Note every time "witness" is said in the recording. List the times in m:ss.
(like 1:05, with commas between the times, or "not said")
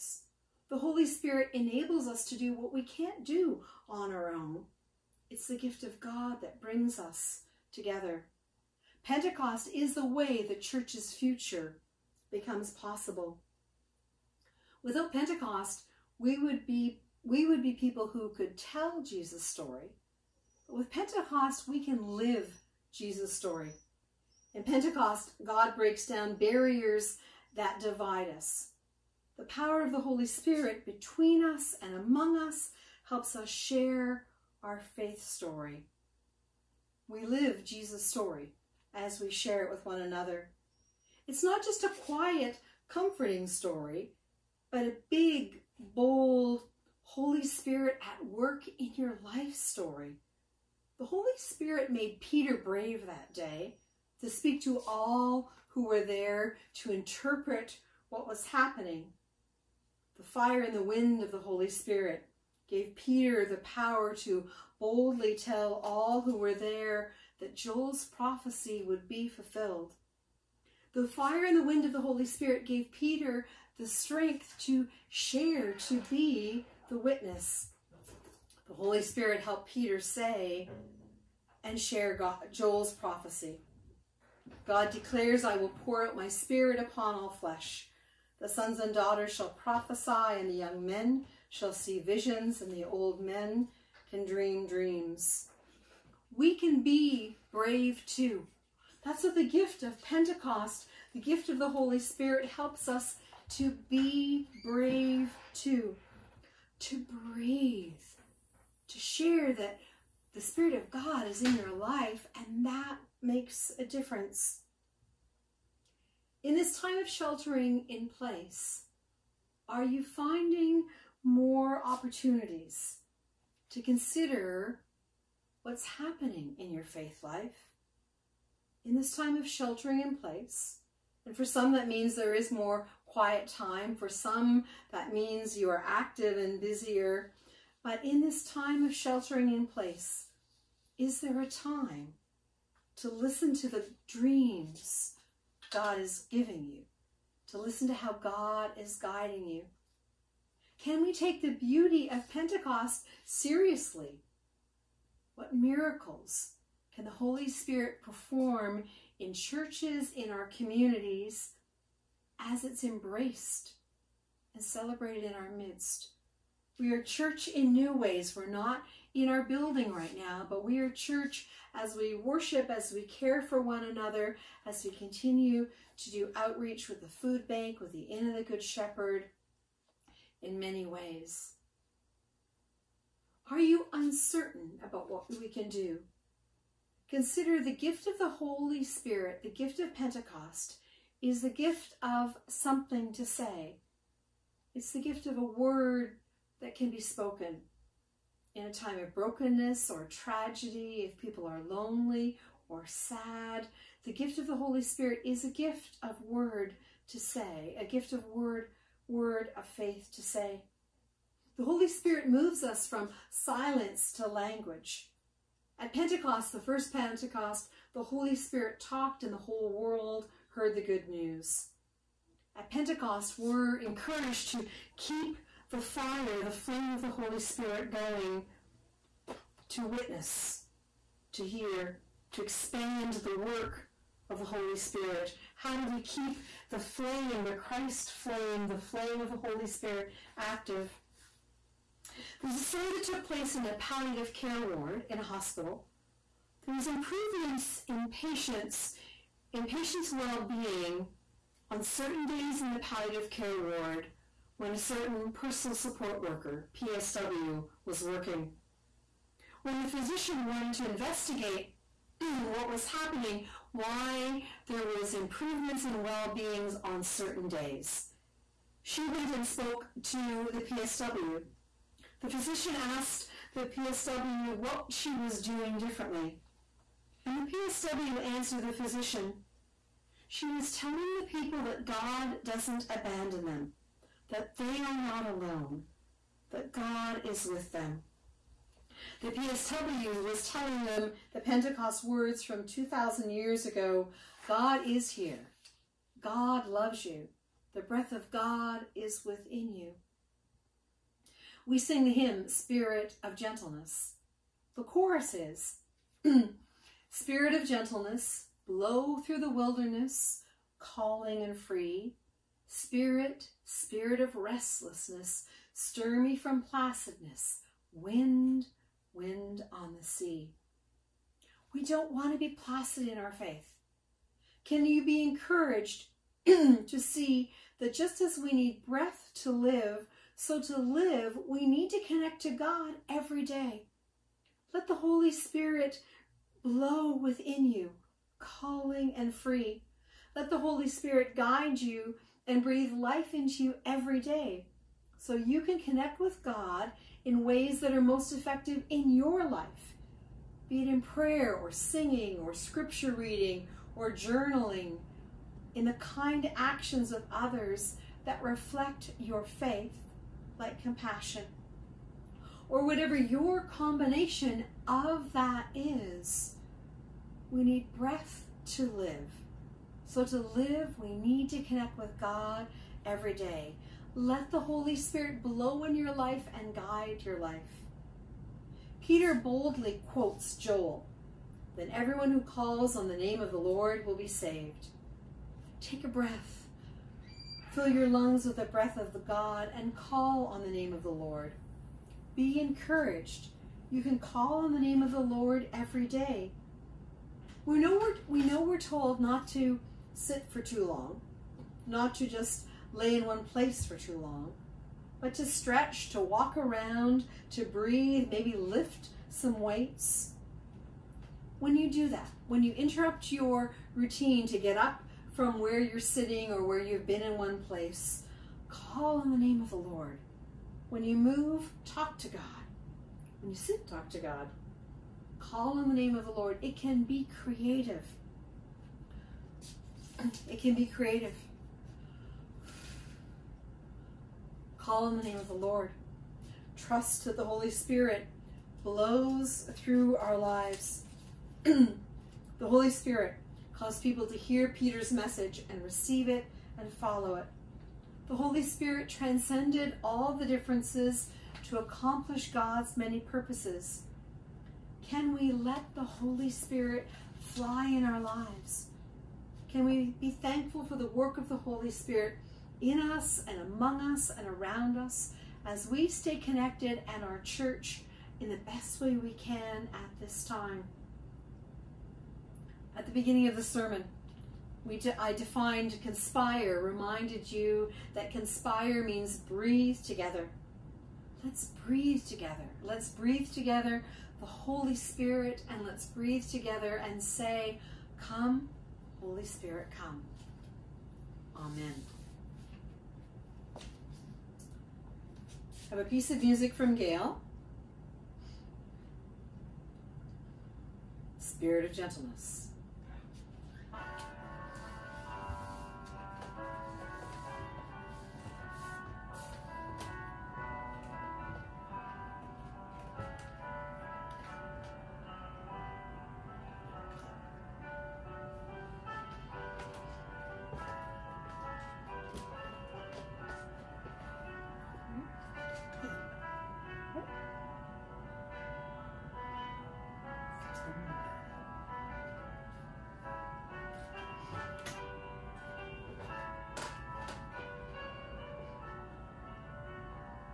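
1:16, 3:49.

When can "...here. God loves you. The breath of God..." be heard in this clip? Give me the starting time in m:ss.
4:55.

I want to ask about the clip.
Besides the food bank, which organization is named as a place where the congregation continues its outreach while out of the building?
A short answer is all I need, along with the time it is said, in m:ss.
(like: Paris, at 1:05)
Inn of the Good Shepherd, at 2:58.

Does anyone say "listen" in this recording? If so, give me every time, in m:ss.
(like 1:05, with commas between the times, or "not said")
2:23, 2:27.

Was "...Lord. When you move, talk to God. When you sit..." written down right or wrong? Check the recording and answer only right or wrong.
right.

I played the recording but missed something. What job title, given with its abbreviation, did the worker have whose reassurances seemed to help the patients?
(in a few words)
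Personal support worker.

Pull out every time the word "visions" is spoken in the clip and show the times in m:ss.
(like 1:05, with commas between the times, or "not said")
1:32.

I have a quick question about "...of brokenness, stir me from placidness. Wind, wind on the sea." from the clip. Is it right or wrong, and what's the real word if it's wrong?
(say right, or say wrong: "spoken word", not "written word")
wrong: "restlessness", not "brokenness".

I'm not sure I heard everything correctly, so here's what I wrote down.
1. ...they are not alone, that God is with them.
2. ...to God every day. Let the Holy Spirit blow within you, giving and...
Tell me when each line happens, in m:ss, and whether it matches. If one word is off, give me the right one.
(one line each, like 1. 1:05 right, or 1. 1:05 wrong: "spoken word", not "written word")
1. 4:44 right
2. 5:32 wrong: "calling", not "giving".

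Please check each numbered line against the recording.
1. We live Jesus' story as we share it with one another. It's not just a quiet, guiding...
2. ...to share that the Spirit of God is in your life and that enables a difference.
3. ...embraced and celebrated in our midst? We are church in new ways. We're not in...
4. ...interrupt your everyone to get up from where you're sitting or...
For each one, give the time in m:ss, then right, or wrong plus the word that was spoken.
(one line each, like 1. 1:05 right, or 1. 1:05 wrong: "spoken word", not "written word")
1. 0:37 wrong: "comforting", not "guiding"
2. 1:48 wrong: "makes", not "enables"
3. 2:42 right
4. 6:52 wrong: "routine", not "everyone".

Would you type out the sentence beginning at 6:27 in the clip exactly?
Fill your lungs with the breath of the God and call on the name of the Lord.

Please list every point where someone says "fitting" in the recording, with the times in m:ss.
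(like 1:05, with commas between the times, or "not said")
not said.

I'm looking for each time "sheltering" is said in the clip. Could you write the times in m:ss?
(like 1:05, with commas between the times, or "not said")
1:57, 2:09, 2:18.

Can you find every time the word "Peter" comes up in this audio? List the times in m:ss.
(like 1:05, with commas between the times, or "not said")
0:52, 1:02, 1:12, 1:19, 6:19, 7:24.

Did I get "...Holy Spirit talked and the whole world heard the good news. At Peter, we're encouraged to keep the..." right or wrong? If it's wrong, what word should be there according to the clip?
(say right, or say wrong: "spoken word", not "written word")
wrong: "Pentecost", not "Peter".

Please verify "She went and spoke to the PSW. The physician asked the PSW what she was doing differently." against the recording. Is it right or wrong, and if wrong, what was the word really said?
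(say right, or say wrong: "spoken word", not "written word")
right.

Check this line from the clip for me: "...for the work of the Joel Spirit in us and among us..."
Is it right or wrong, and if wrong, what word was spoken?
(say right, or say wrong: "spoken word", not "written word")
wrong: "Holy", not "Joel".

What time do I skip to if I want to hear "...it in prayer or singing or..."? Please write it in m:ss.
5:50.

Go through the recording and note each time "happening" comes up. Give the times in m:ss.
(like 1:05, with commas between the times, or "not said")
0:58, 2:05, 4:22.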